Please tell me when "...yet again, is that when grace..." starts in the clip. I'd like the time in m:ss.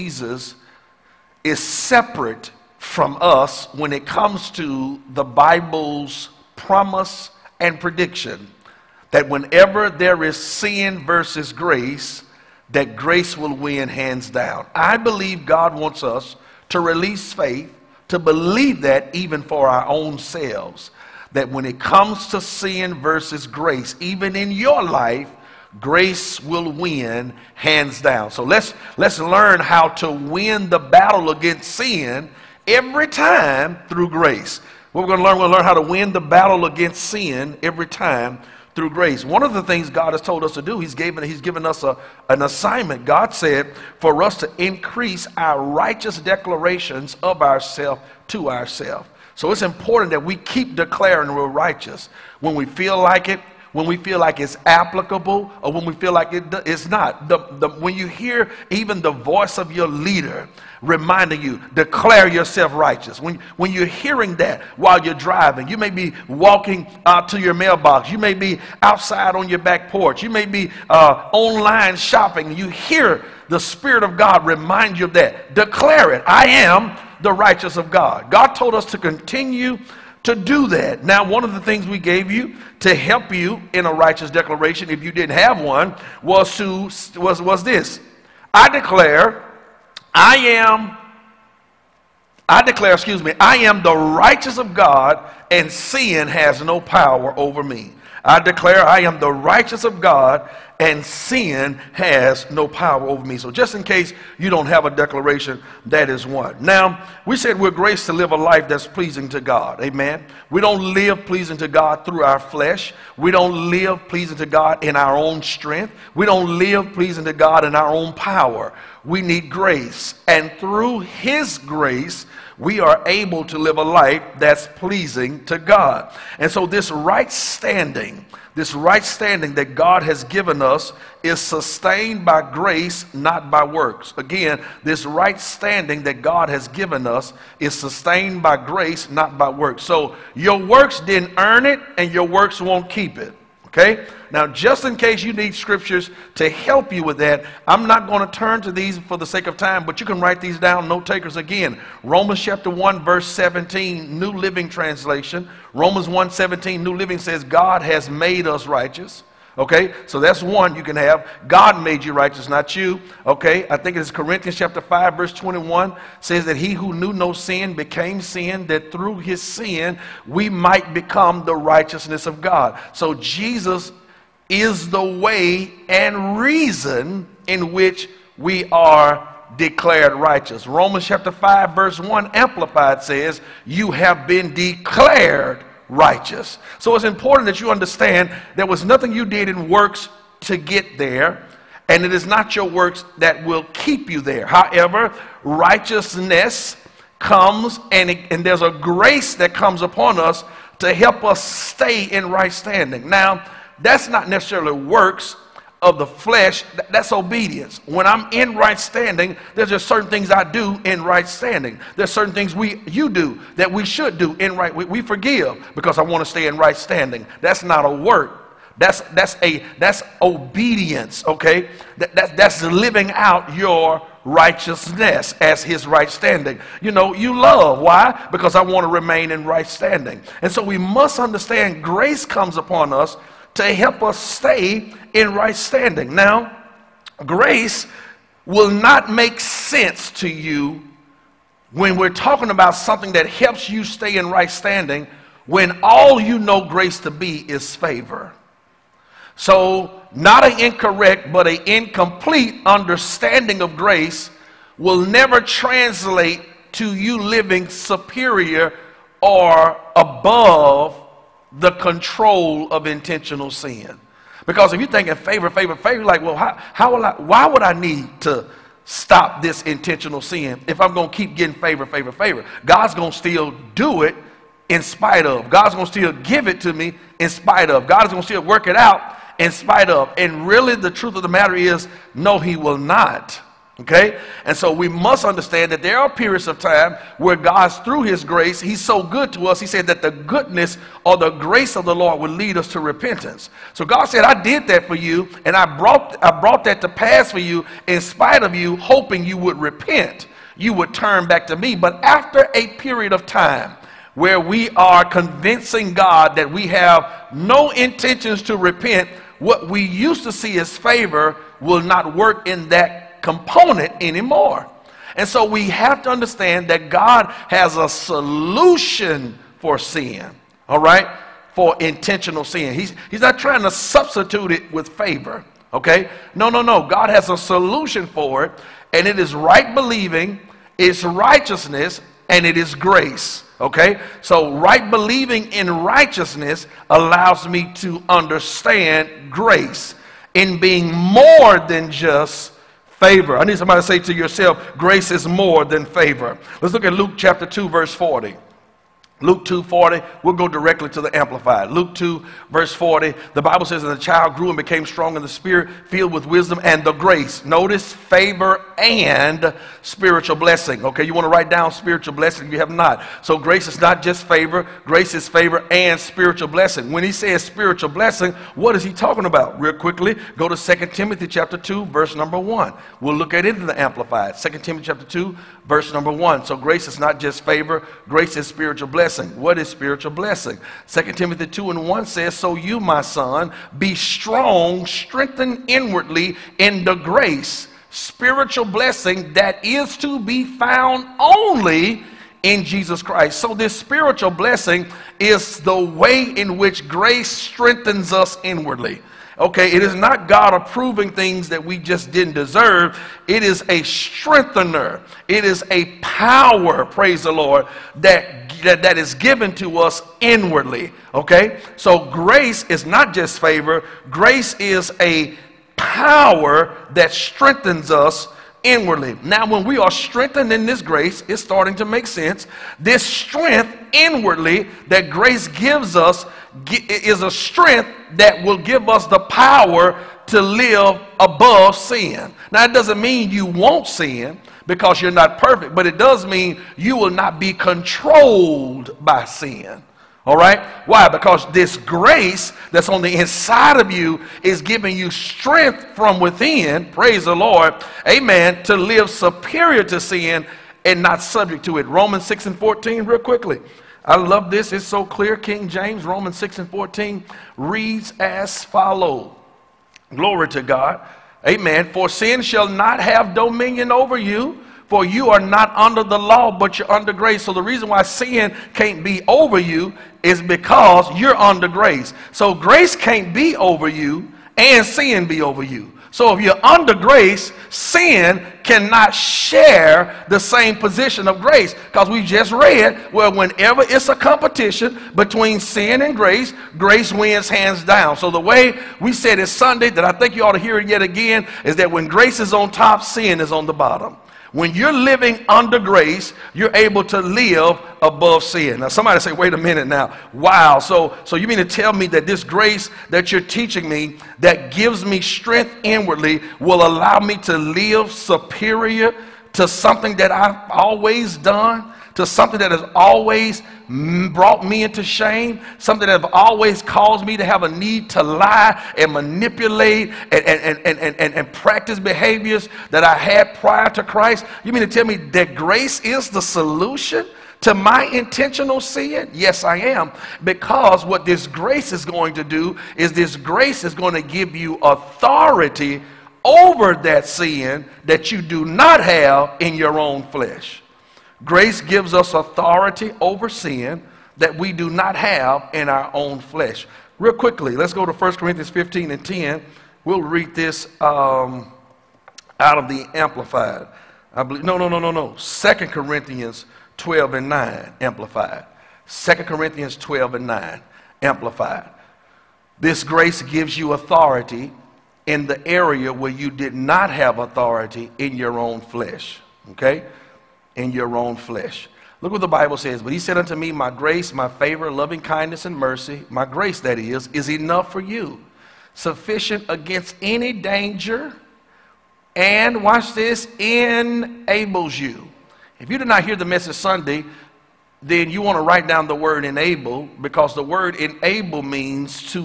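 8:10.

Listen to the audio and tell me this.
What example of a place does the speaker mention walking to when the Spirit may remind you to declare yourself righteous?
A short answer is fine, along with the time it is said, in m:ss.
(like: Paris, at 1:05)
mailbox, at 1:07.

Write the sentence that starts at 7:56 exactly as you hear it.
So if you're under grace, sin cannot share the same position of grace.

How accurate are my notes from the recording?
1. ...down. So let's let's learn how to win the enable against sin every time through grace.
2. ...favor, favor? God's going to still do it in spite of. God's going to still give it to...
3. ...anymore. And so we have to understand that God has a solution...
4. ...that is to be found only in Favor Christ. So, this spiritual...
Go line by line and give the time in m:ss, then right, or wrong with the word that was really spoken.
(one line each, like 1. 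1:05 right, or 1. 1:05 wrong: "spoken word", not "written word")
1. 0:27 wrong: "battle", not "enable"
2. 4:31 right
3. 5:14 right
4. 6:29 wrong: "Jesus", not "Favor".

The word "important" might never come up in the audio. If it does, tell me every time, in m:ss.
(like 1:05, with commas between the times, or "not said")
0:49, 3:07.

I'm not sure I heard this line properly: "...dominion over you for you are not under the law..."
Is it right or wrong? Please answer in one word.
right.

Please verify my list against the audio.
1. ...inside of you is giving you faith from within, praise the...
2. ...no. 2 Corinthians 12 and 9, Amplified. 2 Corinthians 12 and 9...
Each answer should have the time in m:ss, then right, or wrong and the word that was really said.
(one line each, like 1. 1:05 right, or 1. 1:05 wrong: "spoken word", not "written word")
1. 7:23 wrong: "strength", not "faith"
2. 9:15 right.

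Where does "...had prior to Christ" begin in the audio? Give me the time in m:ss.
8:43.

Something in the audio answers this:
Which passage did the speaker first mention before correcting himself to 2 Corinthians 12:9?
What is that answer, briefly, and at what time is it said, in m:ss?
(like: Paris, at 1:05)
1 Corinthians 15:10, at 9:08.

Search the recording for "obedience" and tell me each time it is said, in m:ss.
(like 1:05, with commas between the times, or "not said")
3:27, 3:40.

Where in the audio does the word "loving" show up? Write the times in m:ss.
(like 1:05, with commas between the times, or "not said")
9:34.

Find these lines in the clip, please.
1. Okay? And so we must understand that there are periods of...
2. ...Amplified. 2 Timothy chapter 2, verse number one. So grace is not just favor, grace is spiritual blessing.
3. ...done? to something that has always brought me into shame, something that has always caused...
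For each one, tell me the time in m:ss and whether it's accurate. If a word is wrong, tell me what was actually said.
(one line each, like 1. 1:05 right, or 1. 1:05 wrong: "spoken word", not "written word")
1. 4:43 right
2. 6:13 right
3. 8:31 right.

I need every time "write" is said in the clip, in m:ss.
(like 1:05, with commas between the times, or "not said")
2:30, 6:01, 9:48.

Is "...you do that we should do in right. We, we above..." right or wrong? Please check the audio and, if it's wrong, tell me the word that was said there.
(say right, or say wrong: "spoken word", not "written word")
wrong: "forgive", not "above".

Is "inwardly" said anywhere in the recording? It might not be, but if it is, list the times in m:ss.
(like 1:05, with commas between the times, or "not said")
6:25, 6:38, 6:50, 6:58, 7:03, 8:25.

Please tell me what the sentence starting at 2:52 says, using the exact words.
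So Jesus is the way and reason in which we are declared righteous.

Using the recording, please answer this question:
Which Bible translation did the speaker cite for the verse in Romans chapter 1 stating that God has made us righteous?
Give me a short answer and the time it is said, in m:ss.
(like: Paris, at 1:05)
New Living Translation, at 2:34.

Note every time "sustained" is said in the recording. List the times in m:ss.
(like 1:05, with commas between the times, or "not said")
2:11, 2:17.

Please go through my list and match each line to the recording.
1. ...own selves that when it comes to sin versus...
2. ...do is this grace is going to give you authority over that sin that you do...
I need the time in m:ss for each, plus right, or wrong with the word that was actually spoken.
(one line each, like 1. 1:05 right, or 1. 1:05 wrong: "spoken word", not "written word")
1. 0:19 right
2. 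8:52 right.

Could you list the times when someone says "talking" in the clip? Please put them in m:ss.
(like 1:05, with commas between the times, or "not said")
4:02, 6:08.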